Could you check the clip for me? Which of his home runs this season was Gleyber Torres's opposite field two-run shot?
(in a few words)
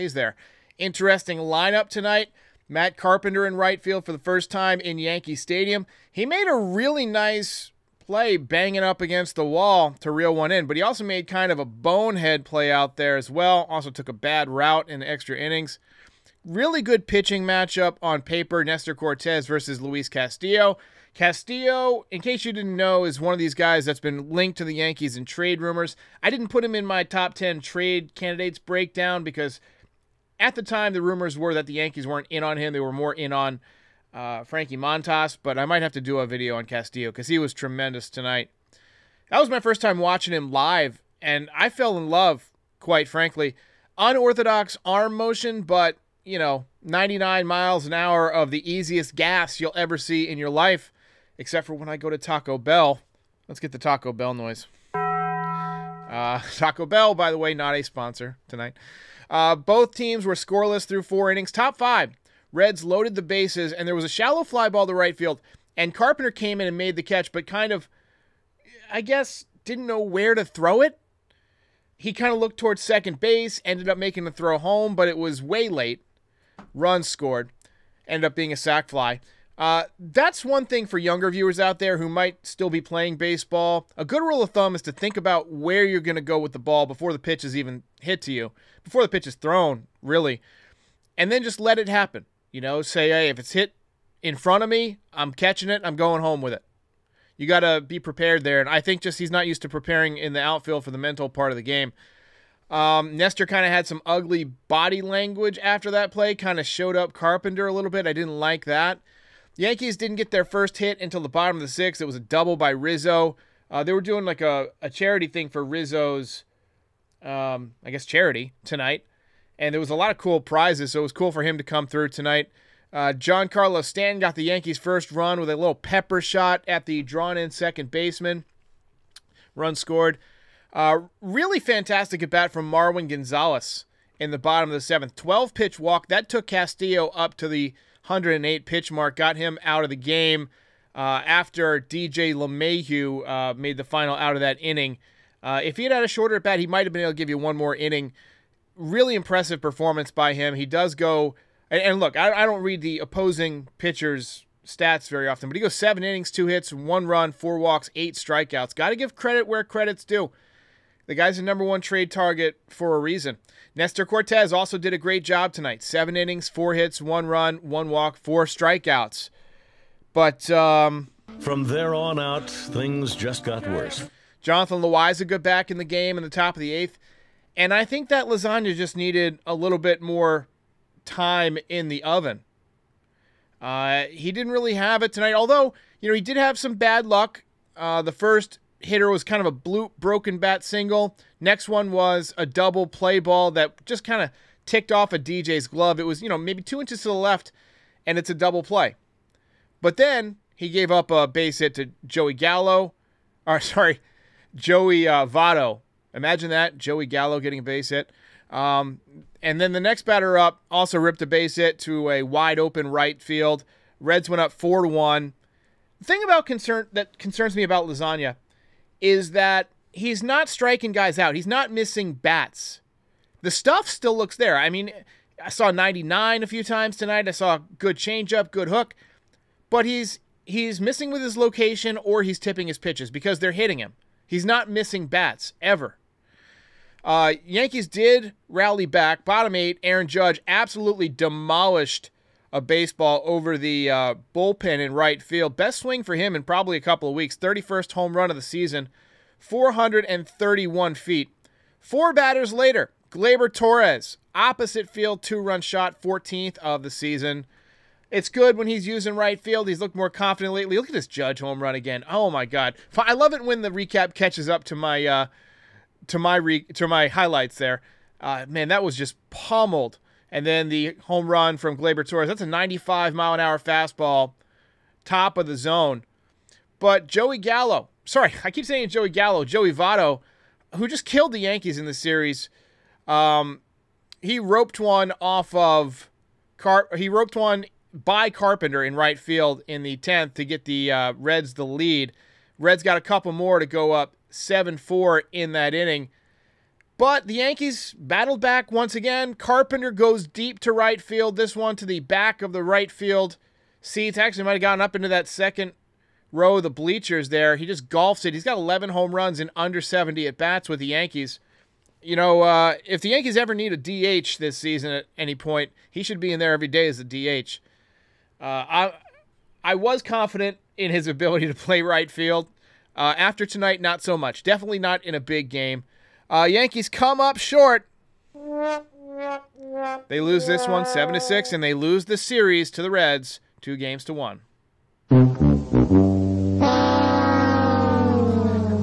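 14th.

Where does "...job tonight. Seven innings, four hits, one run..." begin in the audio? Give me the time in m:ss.
2:45.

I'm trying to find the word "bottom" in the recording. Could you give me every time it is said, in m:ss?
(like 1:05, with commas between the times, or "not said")
1:51, 2:14, 3:59.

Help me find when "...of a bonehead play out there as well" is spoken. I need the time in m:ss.
0:11.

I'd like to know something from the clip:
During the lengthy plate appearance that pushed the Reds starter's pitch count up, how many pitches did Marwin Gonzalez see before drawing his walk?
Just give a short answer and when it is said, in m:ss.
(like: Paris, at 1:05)
12, at 2:15.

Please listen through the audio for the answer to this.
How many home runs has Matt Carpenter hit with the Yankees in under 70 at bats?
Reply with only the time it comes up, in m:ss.
5:08.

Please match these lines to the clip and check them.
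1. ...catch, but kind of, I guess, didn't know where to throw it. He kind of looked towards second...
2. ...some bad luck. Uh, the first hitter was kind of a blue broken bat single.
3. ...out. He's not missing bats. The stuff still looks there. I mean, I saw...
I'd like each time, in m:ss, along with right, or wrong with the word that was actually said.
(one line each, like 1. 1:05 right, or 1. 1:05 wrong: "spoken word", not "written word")
1. 1:07 right
2. 3:06 right
3. 3:41 right.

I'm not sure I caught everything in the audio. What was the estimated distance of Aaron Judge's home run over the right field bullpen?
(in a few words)
431 feet.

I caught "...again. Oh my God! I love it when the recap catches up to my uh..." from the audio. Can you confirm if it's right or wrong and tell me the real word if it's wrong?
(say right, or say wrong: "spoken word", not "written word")
right.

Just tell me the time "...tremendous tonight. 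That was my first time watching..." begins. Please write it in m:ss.
0:37.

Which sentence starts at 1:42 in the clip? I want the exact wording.
Um, Nestor kind of had some ugly body language after that play, kind of showed up Carpenter a little bit.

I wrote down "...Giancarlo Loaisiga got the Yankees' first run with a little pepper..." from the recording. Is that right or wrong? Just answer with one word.
wrong.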